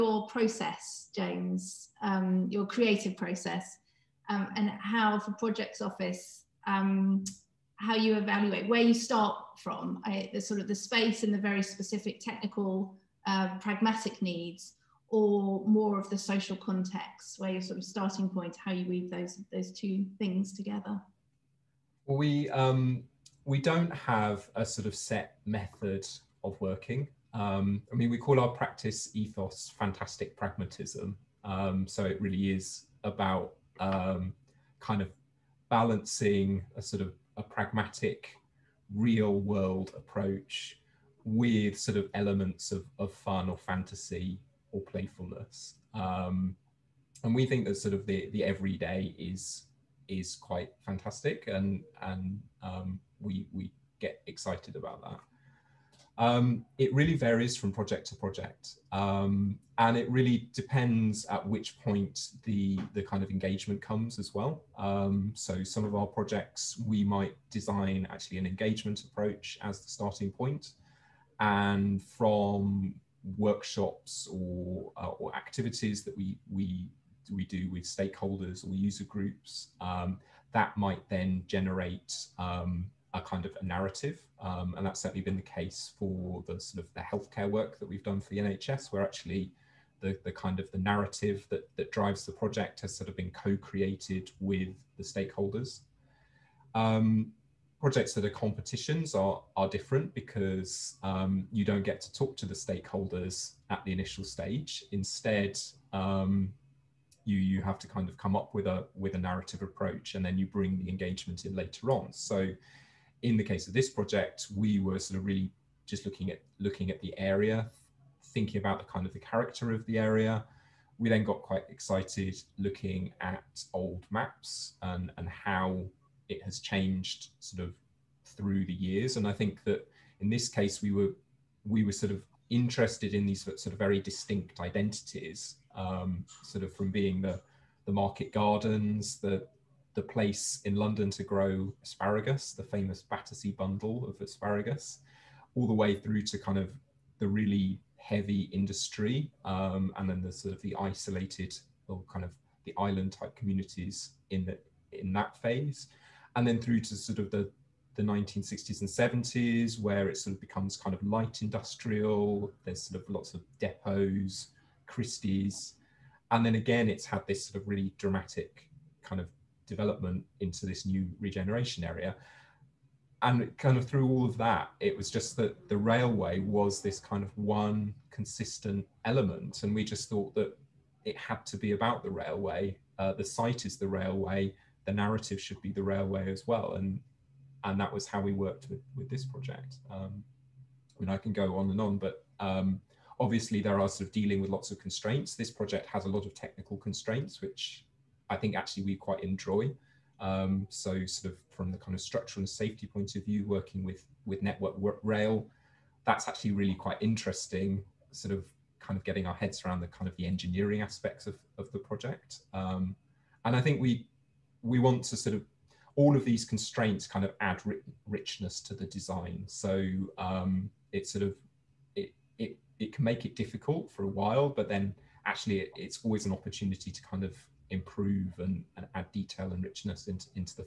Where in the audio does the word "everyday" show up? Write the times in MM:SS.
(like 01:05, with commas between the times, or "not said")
00:48.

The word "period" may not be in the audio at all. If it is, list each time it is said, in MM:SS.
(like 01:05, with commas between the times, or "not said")
not said.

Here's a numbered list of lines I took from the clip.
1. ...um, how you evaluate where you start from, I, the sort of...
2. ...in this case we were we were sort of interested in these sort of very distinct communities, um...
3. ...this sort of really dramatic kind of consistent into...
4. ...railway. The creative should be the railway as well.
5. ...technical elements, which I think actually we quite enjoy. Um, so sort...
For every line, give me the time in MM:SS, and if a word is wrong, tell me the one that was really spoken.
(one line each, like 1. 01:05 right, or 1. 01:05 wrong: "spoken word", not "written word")
1. 00:06 right
2. 02:10 wrong: "identities", not "communities"
3. 02:47 wrong: "development", not "consistent"
4. 03:03 wrong: "narrative", not "creative"
5. 03:16 wrong: "constraints", not "elements".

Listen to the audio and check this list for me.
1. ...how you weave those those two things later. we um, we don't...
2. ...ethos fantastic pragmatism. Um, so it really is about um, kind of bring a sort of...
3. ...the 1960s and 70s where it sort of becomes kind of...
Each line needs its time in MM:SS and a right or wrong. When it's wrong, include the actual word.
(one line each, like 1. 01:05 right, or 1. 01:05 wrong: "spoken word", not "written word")
1. 00:18 wrong: "together", not "later"
2. 00:29 wrong: "balancing", not "bring"
3. 02:37 right.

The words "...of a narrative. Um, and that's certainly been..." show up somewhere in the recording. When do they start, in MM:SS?
01:23.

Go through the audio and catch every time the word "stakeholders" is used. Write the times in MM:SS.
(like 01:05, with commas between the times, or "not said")
01:17, 01:35, 01:42.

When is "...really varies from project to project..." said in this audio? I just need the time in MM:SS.
00:56.